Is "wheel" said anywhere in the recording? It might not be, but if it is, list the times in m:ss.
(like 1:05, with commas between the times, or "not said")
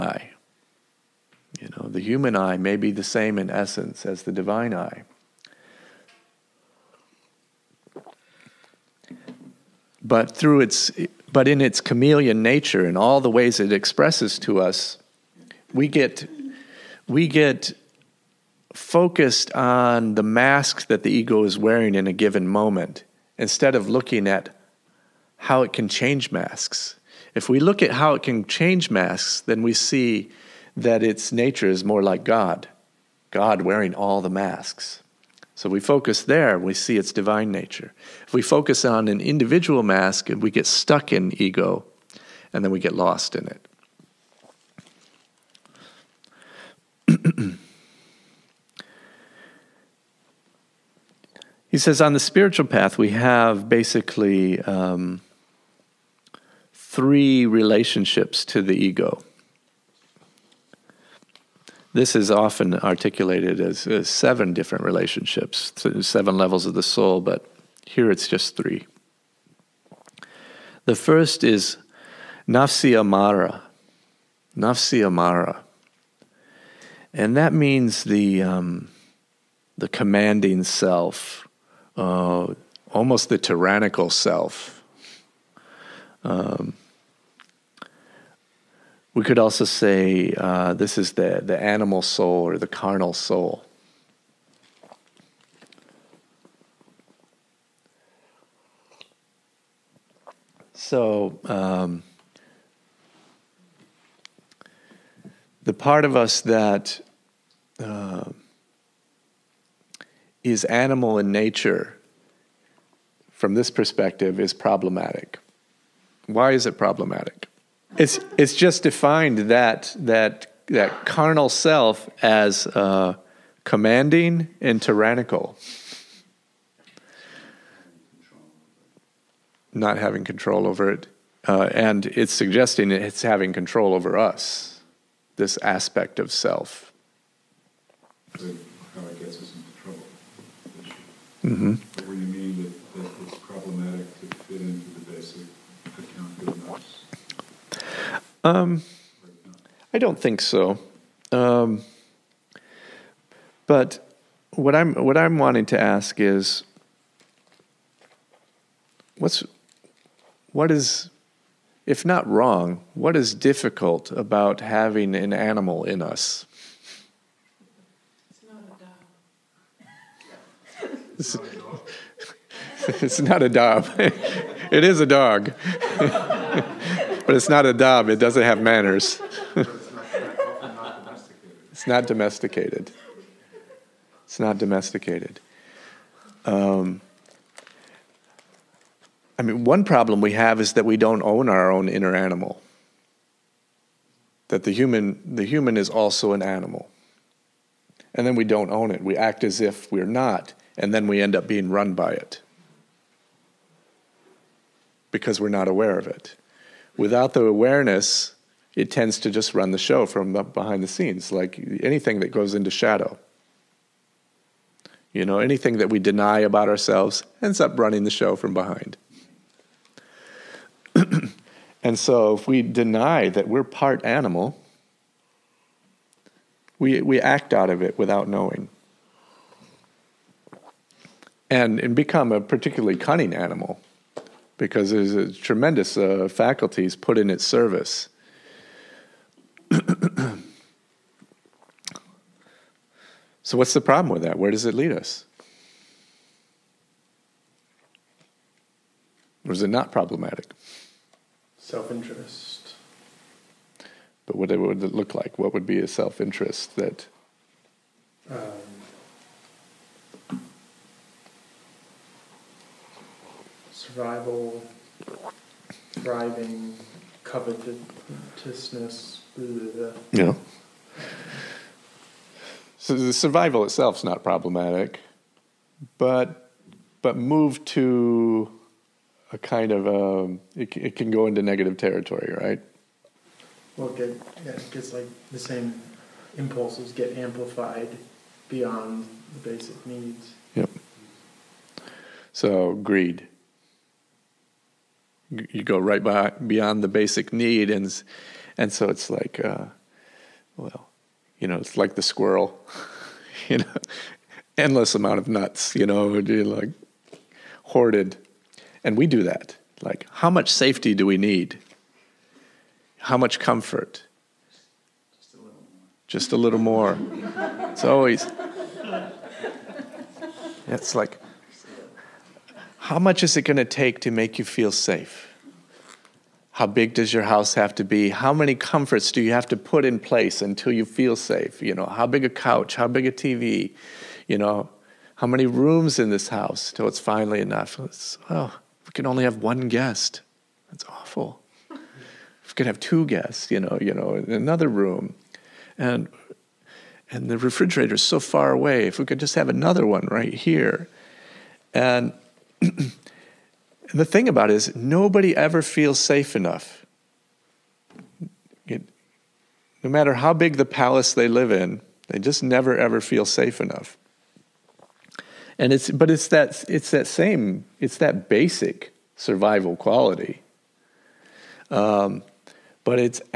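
not said.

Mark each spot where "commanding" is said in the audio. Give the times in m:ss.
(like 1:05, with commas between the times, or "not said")
1:19, 2:03.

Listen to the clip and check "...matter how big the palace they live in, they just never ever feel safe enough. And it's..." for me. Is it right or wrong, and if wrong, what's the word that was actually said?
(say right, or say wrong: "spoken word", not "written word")
right.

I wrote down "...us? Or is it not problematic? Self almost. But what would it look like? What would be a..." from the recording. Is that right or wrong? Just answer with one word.
wrong.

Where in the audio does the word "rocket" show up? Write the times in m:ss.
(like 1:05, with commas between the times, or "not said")
not said.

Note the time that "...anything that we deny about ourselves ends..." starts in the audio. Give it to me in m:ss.
3:35.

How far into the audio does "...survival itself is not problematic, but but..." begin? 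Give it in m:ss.
4:33.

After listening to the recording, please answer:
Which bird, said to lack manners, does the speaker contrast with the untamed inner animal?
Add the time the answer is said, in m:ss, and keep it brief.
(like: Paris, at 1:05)
dove, at 2:57.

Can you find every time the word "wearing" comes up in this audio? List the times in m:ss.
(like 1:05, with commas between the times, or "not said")
0:21, 0:33.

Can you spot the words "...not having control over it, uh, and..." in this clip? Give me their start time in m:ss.
2:09.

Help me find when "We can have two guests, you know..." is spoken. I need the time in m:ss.
5:41.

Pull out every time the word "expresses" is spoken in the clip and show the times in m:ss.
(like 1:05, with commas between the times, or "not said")
0:13.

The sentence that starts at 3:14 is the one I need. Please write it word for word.
That the human, the human is also an animal.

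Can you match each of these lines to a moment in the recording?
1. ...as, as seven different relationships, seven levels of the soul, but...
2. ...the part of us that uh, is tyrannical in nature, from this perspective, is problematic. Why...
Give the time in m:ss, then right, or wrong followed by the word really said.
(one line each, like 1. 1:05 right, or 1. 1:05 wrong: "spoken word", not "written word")
1. 1:03 right
2. 1:45 wrong: "animal", not "tyrannical".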